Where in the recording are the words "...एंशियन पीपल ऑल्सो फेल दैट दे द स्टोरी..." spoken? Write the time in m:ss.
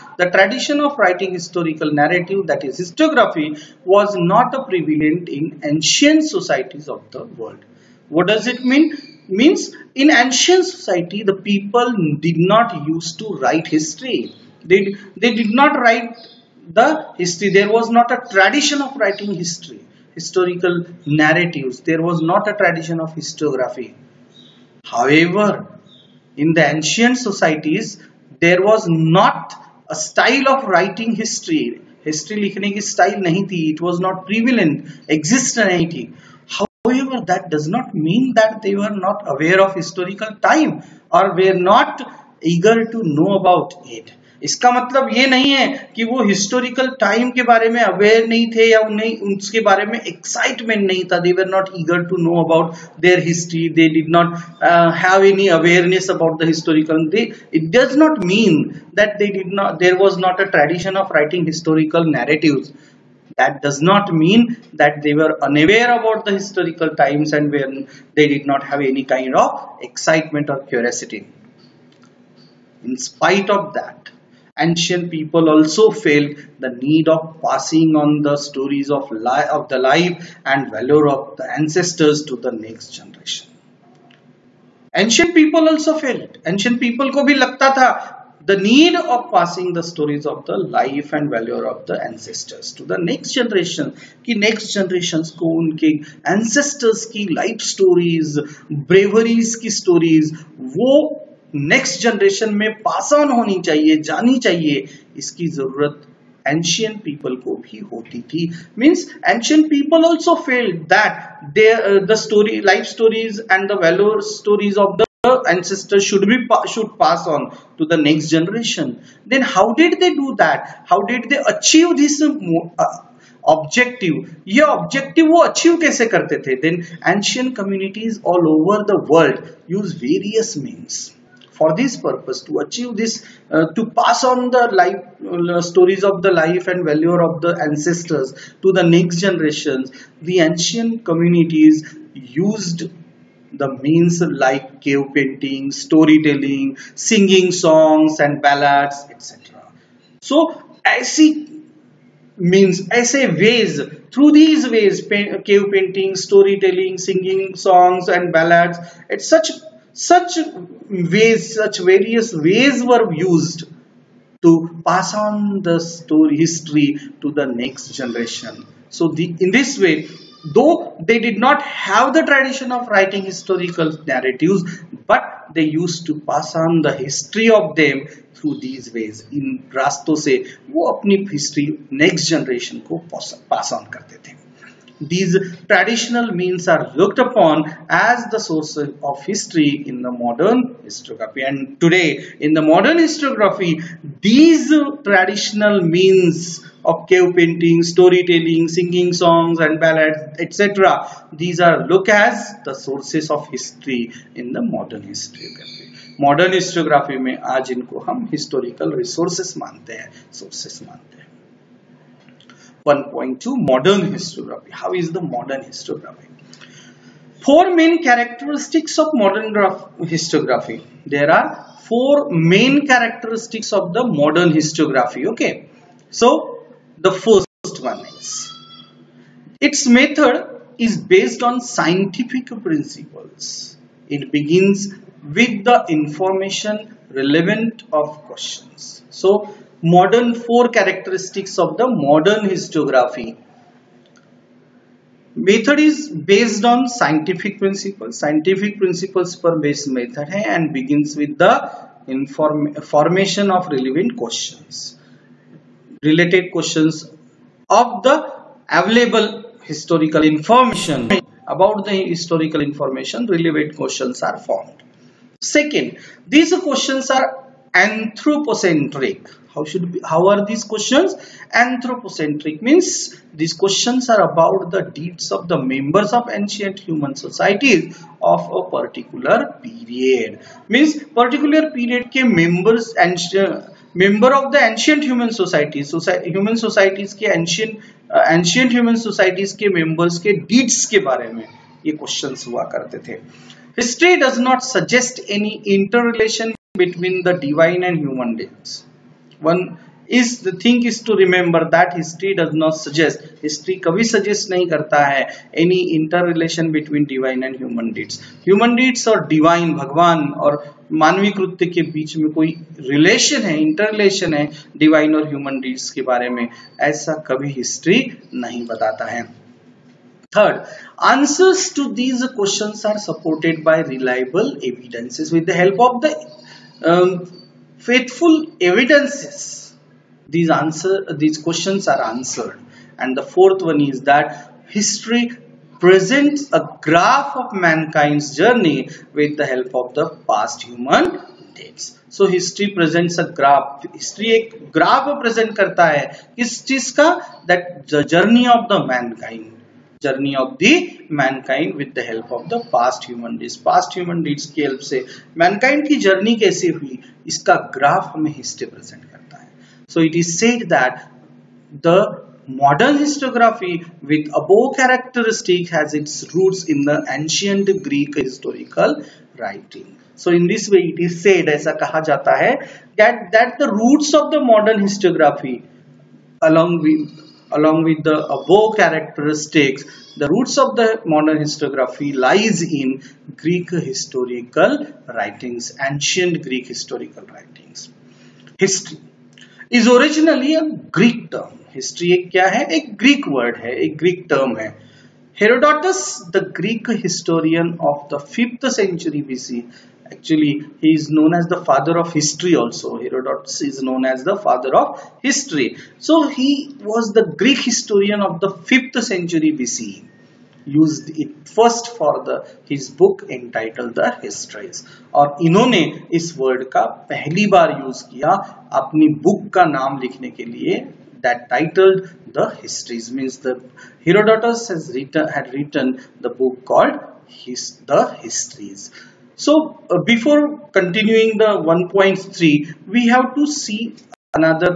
1:49.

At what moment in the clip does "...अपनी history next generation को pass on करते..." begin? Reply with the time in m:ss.
3:00.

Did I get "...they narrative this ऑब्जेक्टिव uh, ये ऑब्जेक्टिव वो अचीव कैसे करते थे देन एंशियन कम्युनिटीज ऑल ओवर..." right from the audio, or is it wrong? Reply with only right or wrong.
wrong.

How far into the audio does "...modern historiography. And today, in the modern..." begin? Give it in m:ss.
3:10.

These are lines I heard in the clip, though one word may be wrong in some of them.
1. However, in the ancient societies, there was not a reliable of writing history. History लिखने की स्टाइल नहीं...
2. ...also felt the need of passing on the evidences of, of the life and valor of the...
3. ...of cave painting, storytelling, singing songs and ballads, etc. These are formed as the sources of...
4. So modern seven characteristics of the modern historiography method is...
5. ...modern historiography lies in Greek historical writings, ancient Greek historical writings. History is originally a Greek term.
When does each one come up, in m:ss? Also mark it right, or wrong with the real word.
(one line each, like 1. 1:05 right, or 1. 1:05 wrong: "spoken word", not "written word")
1. 0:24 wrong: "style", not "reliable"
2. 1:15 wrong: "stories", not "evidences"
3. 3:16 wrong: "looked", not "formed"
4. 3:59 wrong: "four", not "seven"
5. 6:21 right.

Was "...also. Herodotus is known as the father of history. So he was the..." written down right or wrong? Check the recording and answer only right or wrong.
right.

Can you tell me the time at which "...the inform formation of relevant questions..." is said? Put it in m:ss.
4:11.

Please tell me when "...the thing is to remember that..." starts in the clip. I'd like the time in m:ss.
5:00.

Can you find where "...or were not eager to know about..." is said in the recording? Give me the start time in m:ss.
0:41.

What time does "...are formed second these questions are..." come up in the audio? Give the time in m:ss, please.
4:24.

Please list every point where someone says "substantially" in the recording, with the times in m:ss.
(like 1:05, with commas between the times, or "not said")
not said.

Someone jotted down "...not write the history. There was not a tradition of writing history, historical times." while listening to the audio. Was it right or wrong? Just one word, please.
wrong.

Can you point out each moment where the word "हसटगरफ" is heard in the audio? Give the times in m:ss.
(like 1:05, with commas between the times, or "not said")
6:02, 6:14.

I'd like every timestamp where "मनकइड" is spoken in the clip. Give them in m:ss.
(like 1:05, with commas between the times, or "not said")
5:51, 5:55.